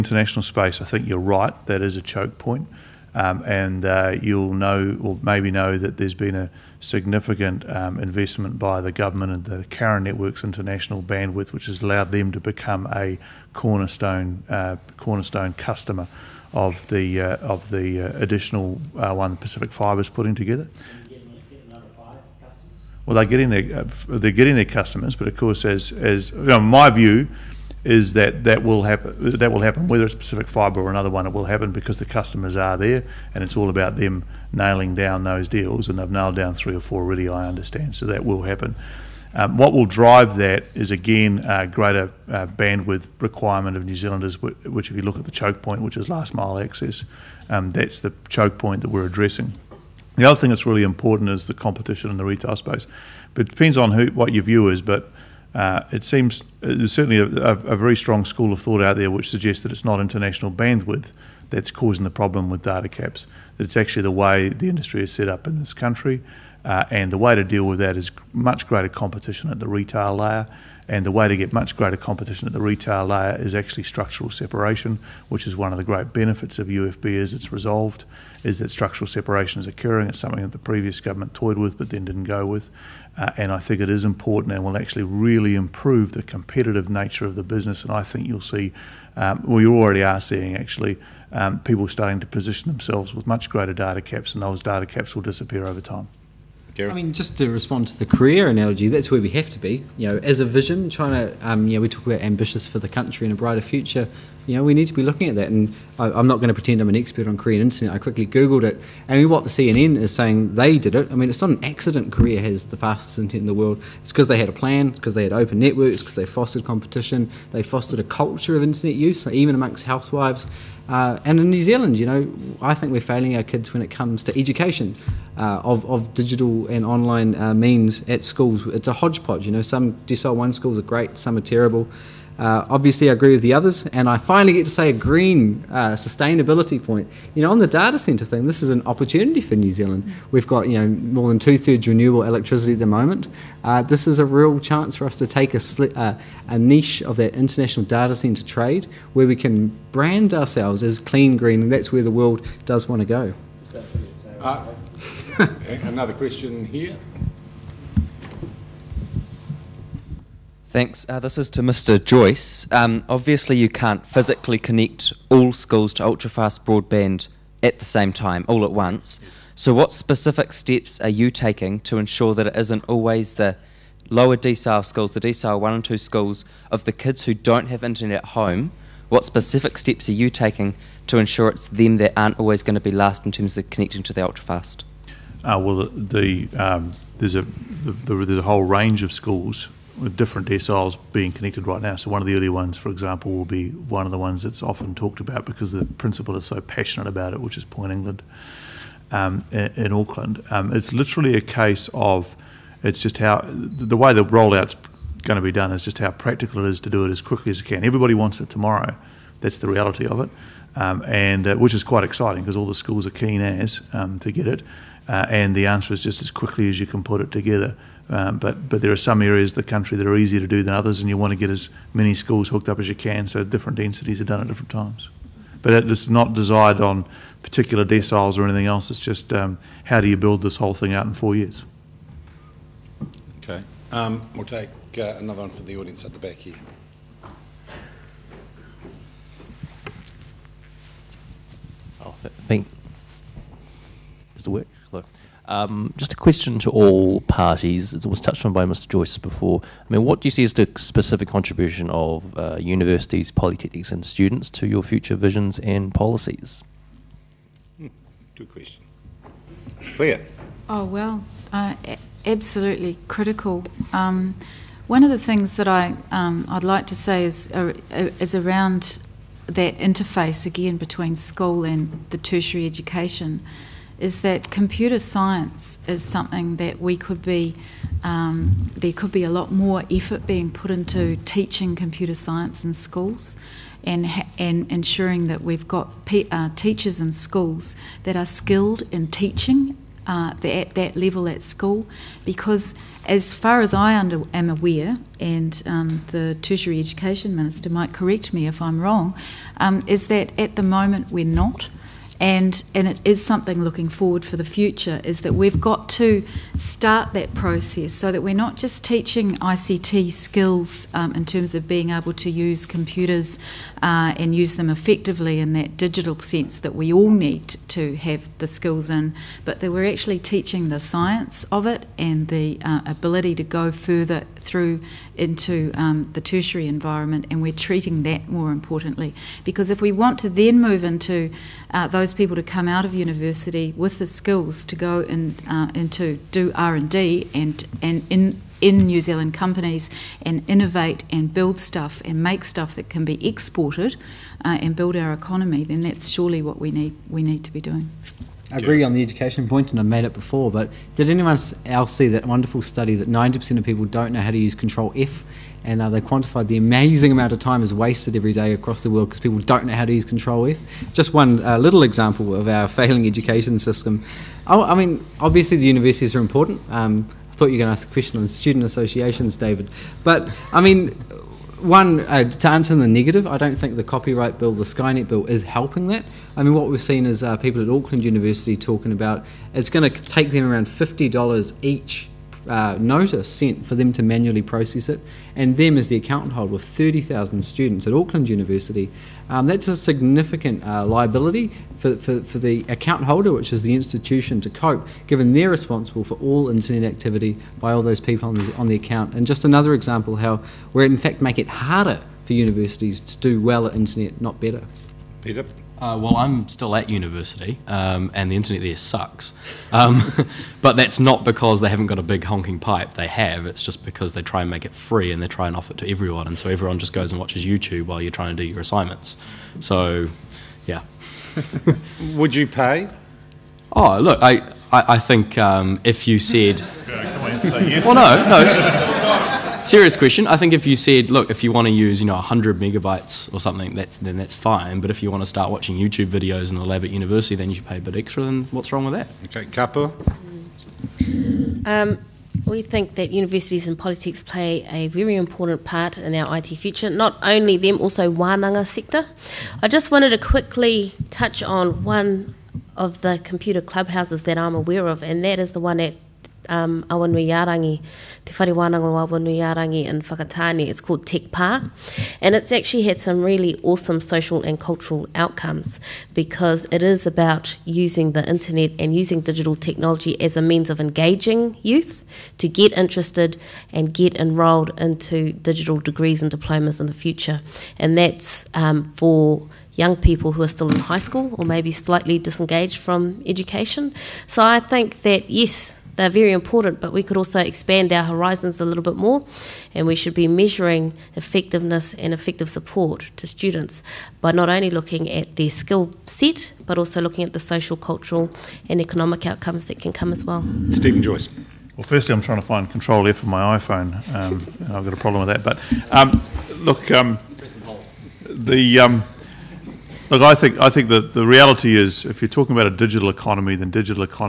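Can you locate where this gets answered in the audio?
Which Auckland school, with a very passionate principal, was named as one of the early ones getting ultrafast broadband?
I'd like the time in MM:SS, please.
03:17.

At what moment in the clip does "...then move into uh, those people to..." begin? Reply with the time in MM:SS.
05:30.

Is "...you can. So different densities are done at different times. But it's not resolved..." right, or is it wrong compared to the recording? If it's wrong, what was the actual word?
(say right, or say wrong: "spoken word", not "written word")
wrong: "desired", not "resolved".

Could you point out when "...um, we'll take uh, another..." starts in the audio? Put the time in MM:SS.
03:53.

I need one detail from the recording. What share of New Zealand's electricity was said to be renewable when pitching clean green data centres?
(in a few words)
more than two thirds.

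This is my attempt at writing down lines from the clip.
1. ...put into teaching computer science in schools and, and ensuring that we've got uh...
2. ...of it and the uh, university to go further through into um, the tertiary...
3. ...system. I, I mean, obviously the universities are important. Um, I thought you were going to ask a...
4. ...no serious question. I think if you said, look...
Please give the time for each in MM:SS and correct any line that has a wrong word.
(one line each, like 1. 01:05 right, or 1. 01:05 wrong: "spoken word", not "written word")
1. 04:40 right
2. 05:21 wrong: "ability", not "university"
3. 06:03 right
4. 07:08 right.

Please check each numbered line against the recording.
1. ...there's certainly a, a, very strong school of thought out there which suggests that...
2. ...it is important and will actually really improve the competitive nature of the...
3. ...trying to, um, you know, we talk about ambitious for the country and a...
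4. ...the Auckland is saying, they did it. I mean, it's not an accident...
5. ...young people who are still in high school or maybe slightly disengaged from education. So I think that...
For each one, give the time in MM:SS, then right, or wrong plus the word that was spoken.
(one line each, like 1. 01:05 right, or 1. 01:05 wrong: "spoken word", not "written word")
1. 00:56 right
2. 01:23 right
3. 01:40 right
4. 01:49 wrong: "CNN", not "Auckland"
5. 07:59 right.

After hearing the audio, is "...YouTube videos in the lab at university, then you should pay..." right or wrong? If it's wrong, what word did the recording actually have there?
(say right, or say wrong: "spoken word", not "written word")
right.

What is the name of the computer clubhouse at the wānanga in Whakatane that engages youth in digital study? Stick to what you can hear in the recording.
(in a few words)
Tekpa.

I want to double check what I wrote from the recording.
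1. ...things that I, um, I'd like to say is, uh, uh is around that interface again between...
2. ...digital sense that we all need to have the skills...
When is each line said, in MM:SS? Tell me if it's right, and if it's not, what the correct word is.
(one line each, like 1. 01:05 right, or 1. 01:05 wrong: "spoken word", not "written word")
1. 04:25 right
2. 05:15 right.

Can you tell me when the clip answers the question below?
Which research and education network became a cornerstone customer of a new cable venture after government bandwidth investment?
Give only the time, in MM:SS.
00:09.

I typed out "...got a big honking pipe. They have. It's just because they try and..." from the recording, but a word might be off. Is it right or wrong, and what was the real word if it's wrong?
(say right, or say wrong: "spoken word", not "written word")
right.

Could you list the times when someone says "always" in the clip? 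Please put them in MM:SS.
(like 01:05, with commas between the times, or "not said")
02:52, 03:02.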